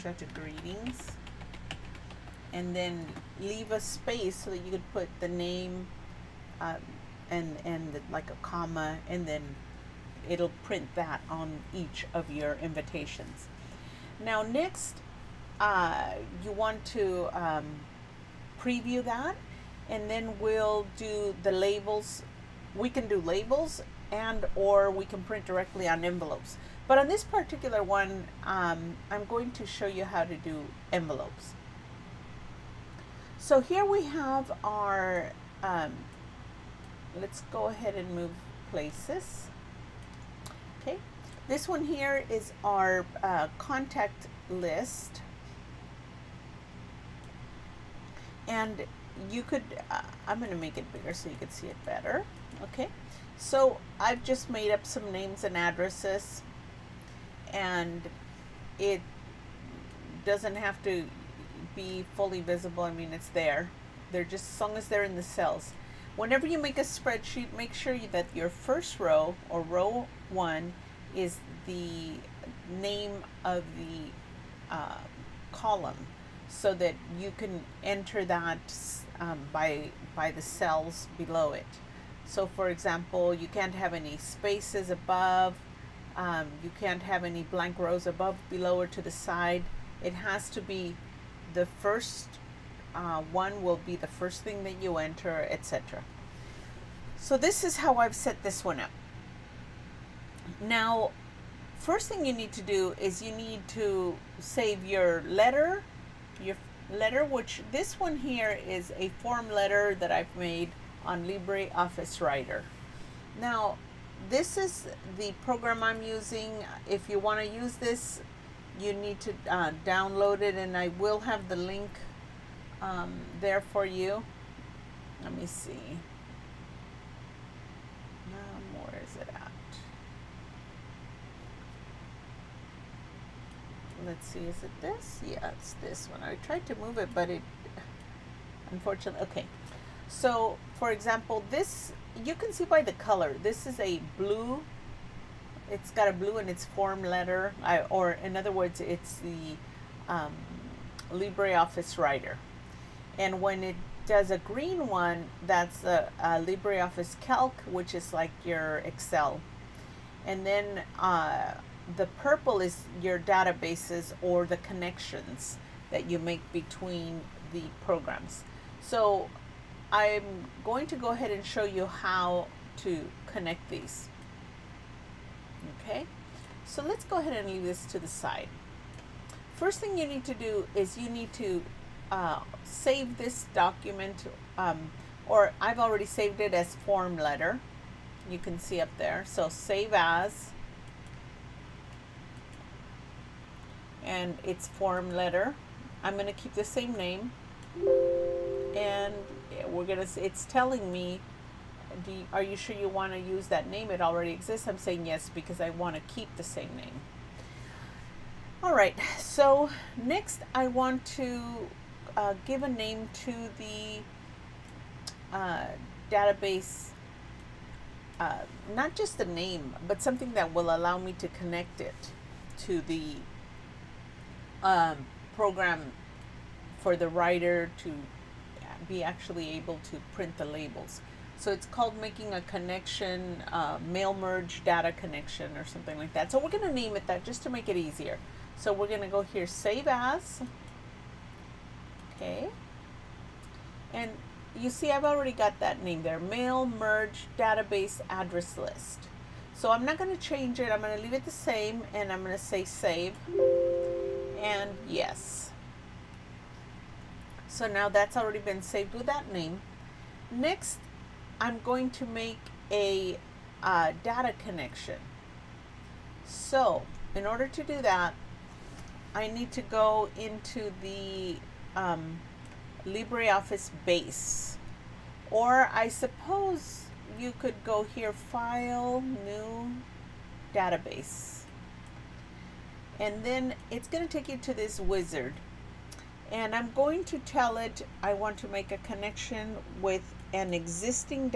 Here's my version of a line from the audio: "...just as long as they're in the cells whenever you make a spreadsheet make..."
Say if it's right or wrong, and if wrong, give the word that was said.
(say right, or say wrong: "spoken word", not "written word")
right.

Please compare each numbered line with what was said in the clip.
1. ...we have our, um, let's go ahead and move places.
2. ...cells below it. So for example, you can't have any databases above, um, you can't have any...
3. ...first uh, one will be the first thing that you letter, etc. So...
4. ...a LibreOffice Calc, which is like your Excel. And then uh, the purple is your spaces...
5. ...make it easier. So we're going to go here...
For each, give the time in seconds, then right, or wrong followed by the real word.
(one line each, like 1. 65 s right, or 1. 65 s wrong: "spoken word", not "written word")
1. 33 s right
2. 80 s wrong: "spaces", not "databases"
3. 91 s wrong: "enter", not "letter"
4. 156 s wrong: "databases", not "spaces"
5. 237 s right.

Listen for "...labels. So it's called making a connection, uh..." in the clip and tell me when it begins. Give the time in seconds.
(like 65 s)
230 s.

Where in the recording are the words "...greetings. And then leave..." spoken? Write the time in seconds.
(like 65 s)
0 s.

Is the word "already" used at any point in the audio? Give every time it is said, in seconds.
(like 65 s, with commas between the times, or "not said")
185 s, 204 s, 245 s, 258 s.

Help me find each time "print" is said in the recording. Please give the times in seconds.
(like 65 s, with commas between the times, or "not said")
10 s, 25 s, 230 s.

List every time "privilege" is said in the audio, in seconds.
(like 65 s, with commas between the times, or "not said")
not said.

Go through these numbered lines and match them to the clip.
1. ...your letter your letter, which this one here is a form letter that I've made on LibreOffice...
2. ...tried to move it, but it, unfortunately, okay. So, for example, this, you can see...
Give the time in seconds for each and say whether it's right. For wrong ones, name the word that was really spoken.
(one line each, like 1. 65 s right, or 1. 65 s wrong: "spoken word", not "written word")
1. 104 s right
2. 136 s right.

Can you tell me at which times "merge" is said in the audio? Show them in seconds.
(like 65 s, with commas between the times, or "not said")
234 s, 246 s.